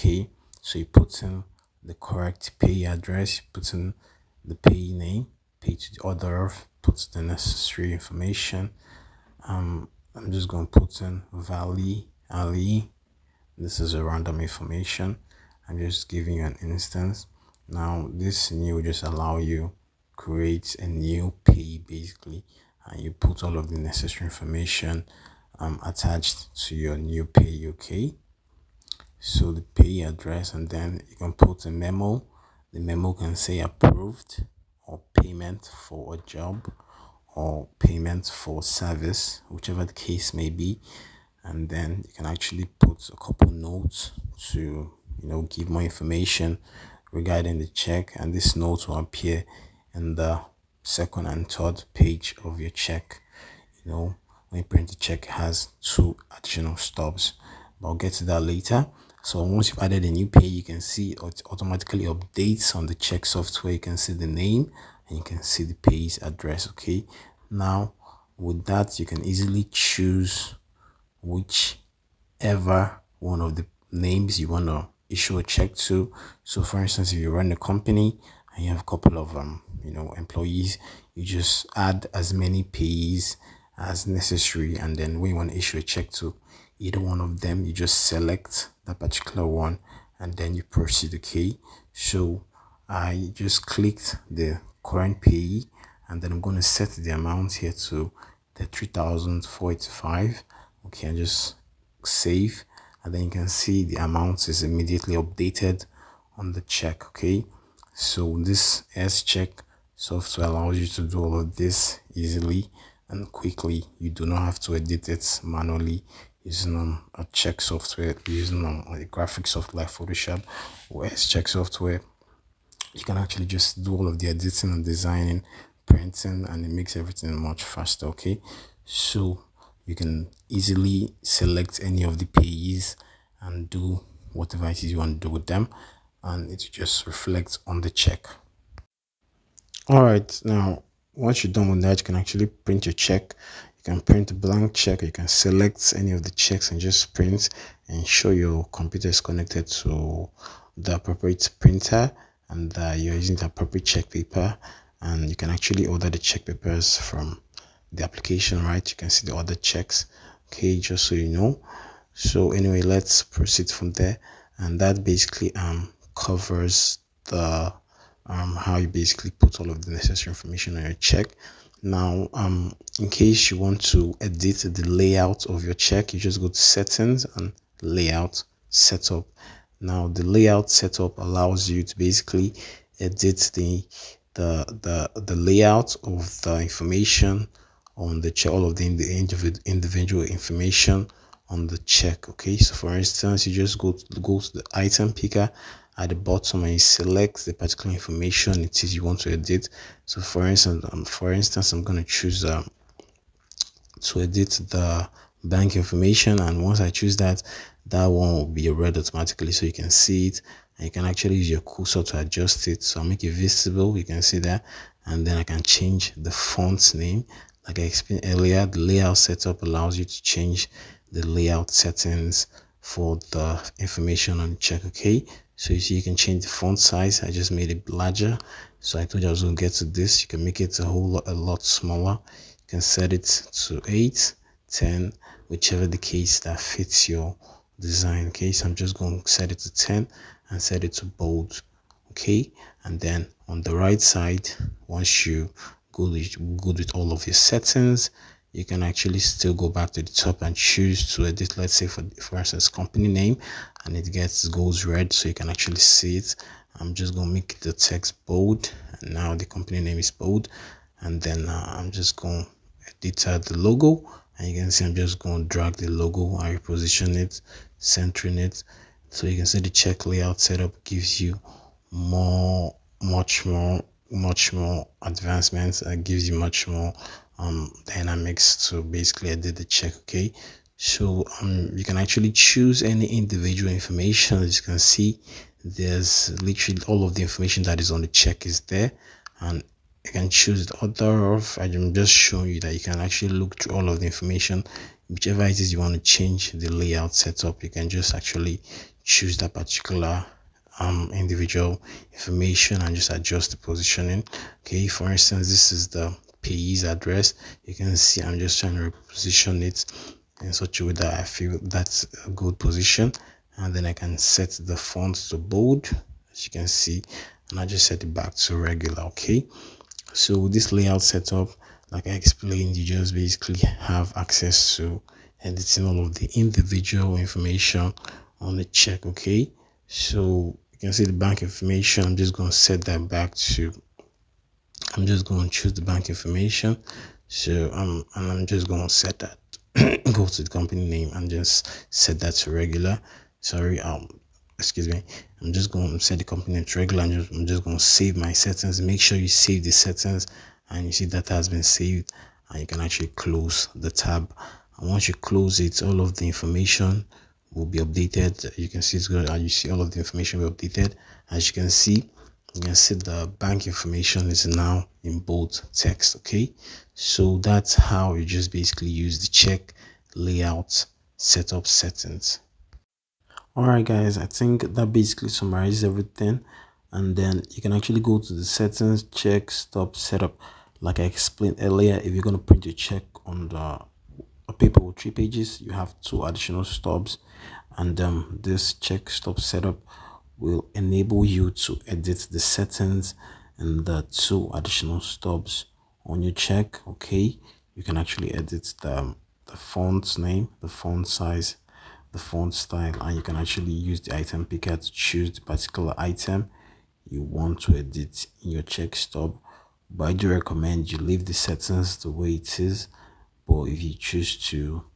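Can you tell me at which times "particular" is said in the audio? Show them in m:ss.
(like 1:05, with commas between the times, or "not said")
1:28, 3:17, 4:59, 6:45.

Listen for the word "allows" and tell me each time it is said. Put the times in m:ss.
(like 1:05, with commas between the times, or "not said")
0:19, 1:50, 3:01, 3:39.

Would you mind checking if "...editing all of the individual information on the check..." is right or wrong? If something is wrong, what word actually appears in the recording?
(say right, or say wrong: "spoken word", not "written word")
right.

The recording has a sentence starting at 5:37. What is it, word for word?
So I'm um, and I'm just going to set that.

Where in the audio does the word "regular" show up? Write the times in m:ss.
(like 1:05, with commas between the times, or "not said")
5:18, 5:42, 5:46.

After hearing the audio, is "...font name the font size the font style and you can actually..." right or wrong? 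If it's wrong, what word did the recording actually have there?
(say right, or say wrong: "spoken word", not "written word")
right.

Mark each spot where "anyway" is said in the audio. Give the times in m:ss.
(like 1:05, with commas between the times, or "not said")
2:42.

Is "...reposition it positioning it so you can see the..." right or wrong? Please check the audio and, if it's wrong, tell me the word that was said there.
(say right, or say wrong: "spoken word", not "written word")
wrong: "centering", not "positioning".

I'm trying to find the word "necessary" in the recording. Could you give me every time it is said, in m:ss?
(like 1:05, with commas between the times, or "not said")
0:07, 0:23, 1:24, 2:49.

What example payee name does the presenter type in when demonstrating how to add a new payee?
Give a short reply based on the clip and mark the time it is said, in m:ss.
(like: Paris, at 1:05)
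Valley Ali, at 0:11.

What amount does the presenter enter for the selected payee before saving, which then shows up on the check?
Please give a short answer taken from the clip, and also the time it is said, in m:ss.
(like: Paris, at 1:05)
3485, at 1:38.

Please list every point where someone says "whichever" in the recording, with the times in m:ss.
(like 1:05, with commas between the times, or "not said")
0:39, 1:11, 3:55, 4:55.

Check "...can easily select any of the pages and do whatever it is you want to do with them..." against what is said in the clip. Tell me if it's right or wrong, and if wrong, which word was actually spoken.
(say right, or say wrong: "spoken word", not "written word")
right.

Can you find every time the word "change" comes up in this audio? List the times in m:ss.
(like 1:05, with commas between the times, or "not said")
3:35, 3:40, 3:46, 4:55.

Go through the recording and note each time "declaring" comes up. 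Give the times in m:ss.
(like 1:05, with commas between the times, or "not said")
not said.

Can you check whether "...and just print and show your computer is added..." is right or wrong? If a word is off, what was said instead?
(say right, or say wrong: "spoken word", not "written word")
wrong: "connected", not "added".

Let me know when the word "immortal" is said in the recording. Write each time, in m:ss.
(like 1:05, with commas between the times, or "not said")
not said.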